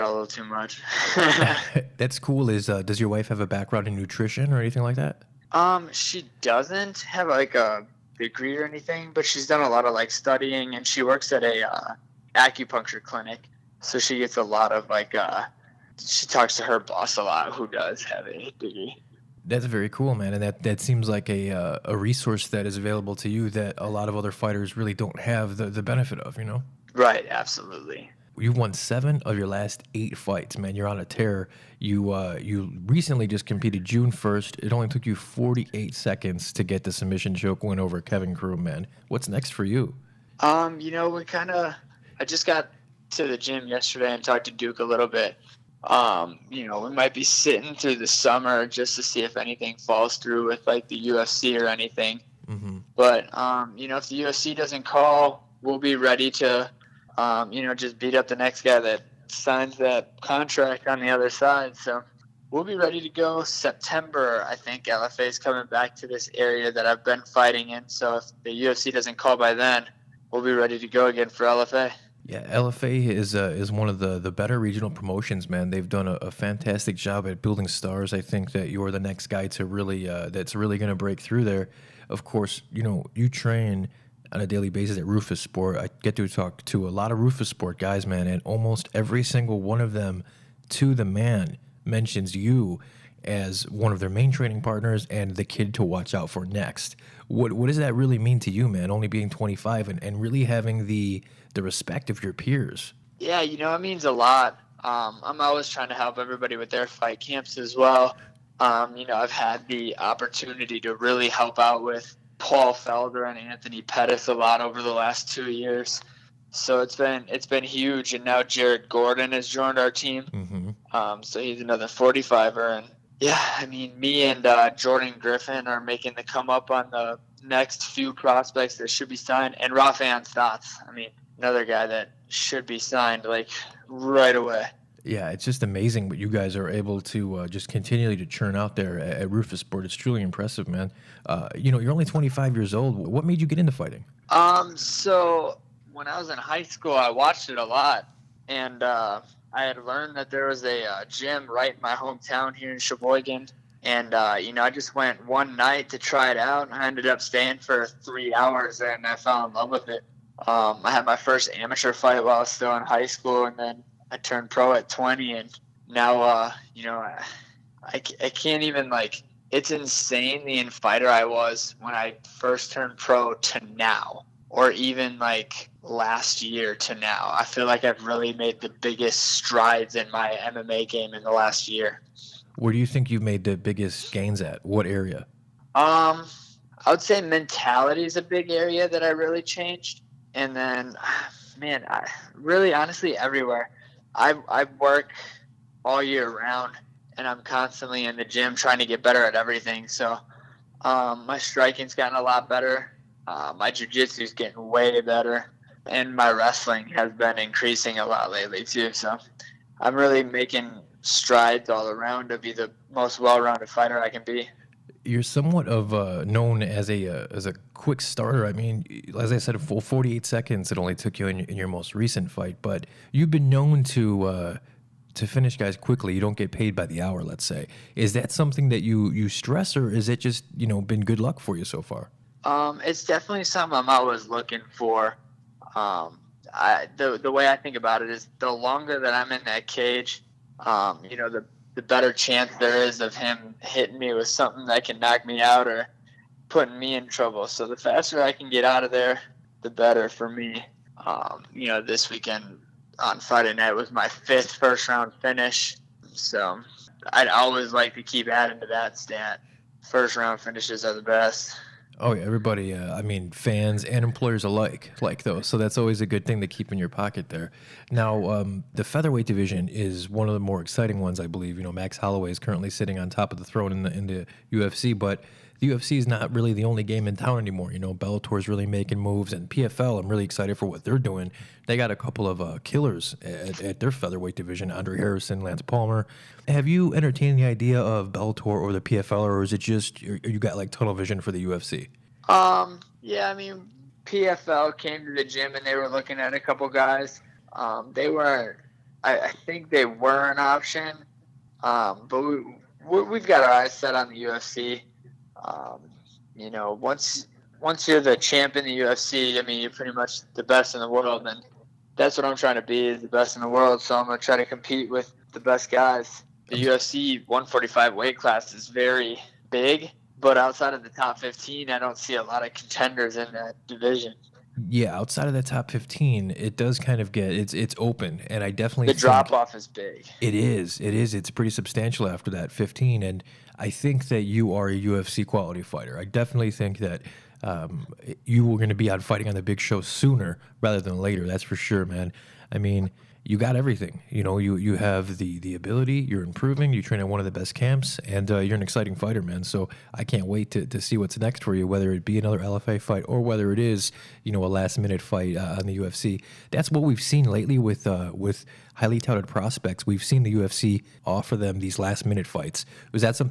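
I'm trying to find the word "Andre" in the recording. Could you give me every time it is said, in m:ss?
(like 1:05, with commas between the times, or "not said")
4:44.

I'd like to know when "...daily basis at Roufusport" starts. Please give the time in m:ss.
1:24.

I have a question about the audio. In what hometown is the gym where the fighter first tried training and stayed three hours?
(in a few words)
Sheboygan.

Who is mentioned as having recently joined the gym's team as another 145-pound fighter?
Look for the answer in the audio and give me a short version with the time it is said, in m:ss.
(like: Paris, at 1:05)
Jared Gordon, at 1:58.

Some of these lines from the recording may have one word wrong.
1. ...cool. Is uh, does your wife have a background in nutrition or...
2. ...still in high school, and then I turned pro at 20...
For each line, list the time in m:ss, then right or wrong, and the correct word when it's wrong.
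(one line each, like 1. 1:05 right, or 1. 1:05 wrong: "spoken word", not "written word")
1. 0:02 right
2. 2:42 right.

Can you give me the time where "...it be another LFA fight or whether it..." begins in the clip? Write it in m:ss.
5:51.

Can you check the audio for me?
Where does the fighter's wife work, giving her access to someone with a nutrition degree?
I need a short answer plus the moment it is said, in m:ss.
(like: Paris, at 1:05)
acupuncture clinic, at 0:12.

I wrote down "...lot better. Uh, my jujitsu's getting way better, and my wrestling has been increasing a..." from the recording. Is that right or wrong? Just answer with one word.
right.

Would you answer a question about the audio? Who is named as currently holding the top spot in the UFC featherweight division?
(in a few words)
Max Holloway.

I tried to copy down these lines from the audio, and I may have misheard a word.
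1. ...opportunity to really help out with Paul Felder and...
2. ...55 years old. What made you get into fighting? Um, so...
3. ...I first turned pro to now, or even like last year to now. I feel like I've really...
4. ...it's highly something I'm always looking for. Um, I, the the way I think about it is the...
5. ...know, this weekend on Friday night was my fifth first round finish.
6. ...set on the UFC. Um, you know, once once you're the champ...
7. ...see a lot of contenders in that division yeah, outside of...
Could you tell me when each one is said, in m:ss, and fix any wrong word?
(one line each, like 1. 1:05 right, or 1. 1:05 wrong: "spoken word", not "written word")
1. 1:49 right
2. 2:22 wrong: "25", not "55"
3. 2:51 right
4. 3:52 wrong: "definitely", not "highly"
5. 4:11 right
6. 5:03 right
7. 5:21 right.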